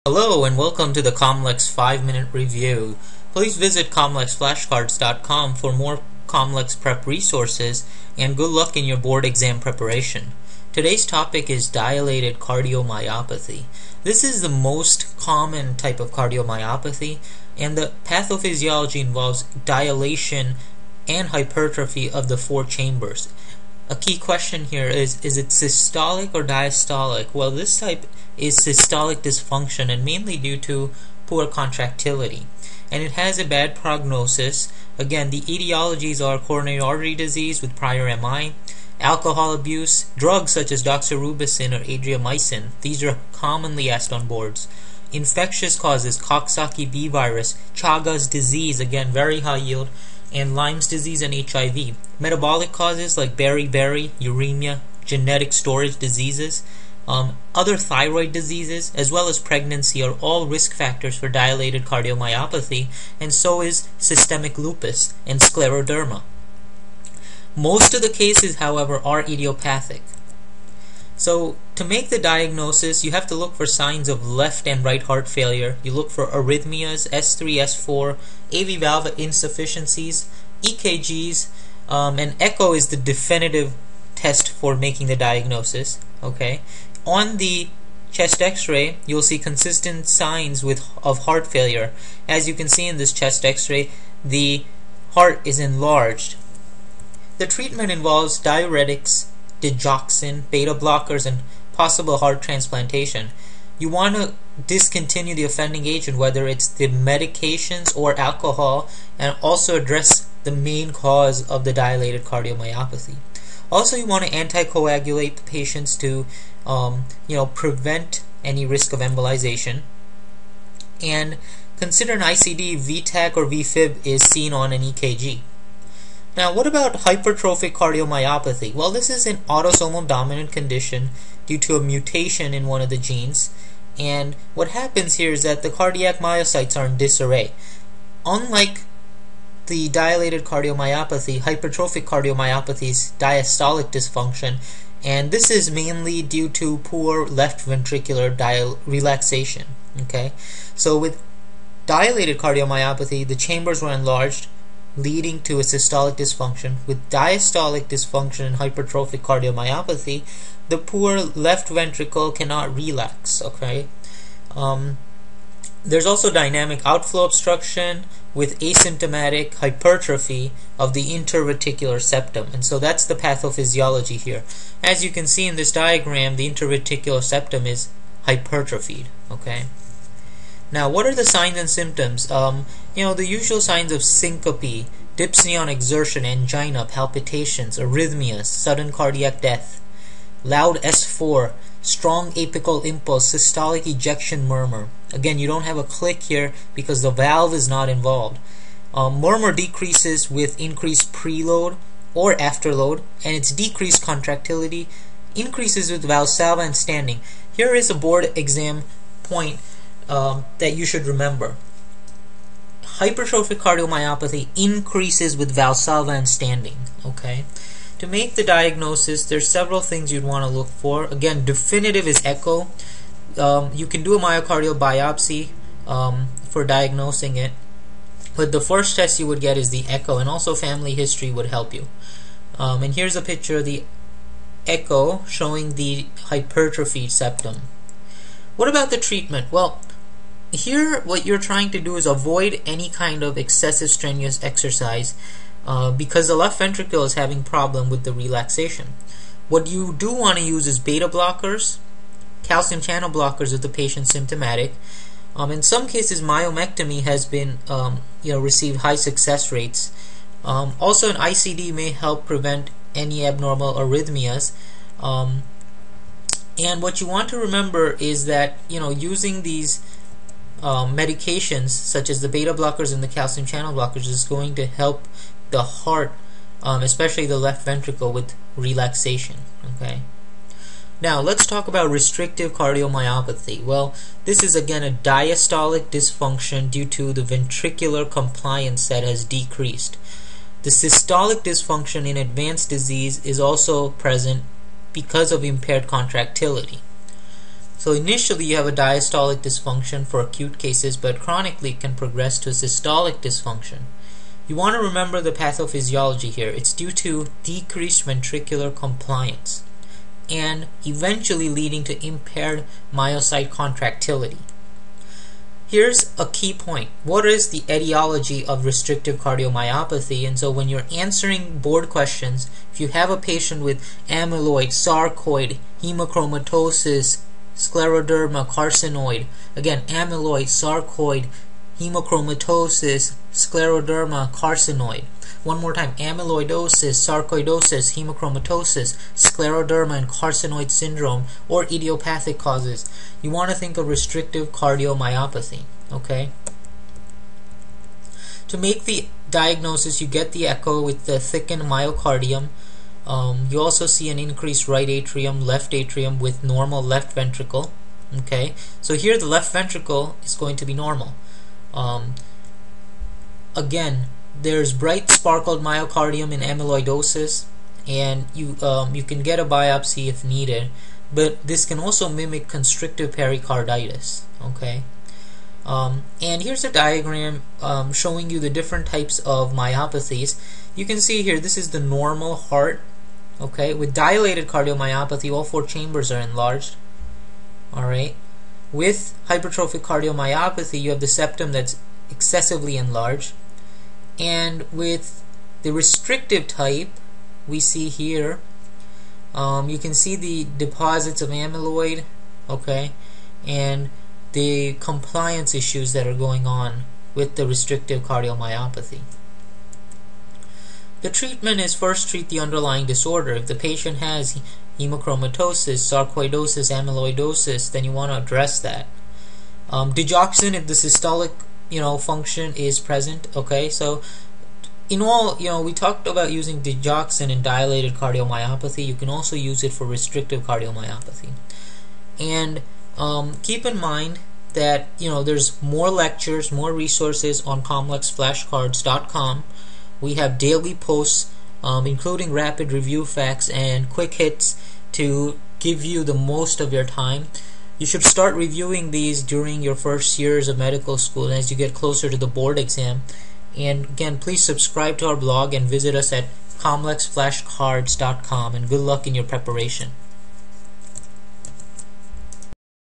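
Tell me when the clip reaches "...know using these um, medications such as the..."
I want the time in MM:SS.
04:28.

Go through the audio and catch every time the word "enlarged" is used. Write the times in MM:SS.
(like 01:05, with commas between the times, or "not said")
01:35, 02:33, 06:26, 06:32.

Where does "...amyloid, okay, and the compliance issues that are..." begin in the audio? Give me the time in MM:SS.
06:41.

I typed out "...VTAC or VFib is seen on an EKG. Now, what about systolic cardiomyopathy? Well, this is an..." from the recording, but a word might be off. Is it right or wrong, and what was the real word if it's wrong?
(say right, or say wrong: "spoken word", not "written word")
wrong: "hypertrophic", not "systolic".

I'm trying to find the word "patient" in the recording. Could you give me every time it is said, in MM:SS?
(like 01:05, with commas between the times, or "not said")
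01:55, 04:13, 05:23, 06:53.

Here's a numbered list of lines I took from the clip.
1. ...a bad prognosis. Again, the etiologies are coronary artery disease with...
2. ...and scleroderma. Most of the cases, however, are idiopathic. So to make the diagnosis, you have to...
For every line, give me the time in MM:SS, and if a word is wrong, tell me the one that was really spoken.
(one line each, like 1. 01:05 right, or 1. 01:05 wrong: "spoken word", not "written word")
1. 00:33 right
2. 01:05 right.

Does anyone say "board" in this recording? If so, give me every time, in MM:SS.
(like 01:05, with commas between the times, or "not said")
00:08, 00:44, 03:27, 05:21, 07:32.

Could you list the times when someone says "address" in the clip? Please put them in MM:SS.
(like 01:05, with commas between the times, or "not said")
01:49, 06:58.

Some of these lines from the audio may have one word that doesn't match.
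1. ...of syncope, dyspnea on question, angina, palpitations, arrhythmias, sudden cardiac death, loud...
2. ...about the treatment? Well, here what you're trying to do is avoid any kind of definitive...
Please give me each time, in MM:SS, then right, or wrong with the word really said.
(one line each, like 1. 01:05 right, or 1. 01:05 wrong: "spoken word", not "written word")
1. 03:03 wrong: "exertion", not "question"
2. 03:58 wrong: "excessive", not "definitive".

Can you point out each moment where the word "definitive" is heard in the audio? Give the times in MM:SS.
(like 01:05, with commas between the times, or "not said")
01:22, 03:41.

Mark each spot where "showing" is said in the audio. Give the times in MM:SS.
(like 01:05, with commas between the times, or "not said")
03:55, 06:17.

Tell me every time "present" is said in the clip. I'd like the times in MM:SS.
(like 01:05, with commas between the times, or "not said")
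04:53, 07:02.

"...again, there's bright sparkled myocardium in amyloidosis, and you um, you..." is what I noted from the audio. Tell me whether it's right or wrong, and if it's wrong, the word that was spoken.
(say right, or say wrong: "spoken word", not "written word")
right.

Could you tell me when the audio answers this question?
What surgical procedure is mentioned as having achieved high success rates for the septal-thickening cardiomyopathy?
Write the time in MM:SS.
04:16.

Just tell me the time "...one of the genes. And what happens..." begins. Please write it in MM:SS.
02:12.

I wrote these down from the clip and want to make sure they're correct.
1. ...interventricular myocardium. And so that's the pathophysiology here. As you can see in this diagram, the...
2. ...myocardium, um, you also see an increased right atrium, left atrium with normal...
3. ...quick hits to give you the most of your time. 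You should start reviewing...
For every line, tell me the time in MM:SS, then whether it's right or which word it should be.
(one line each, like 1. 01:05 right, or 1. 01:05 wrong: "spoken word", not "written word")
1. 02:51 wrong: "septum", not "myocardium"
2. 05:51 right
3. 07:23 right.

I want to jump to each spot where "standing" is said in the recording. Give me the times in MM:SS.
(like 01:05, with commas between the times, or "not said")
03:26, 03:36.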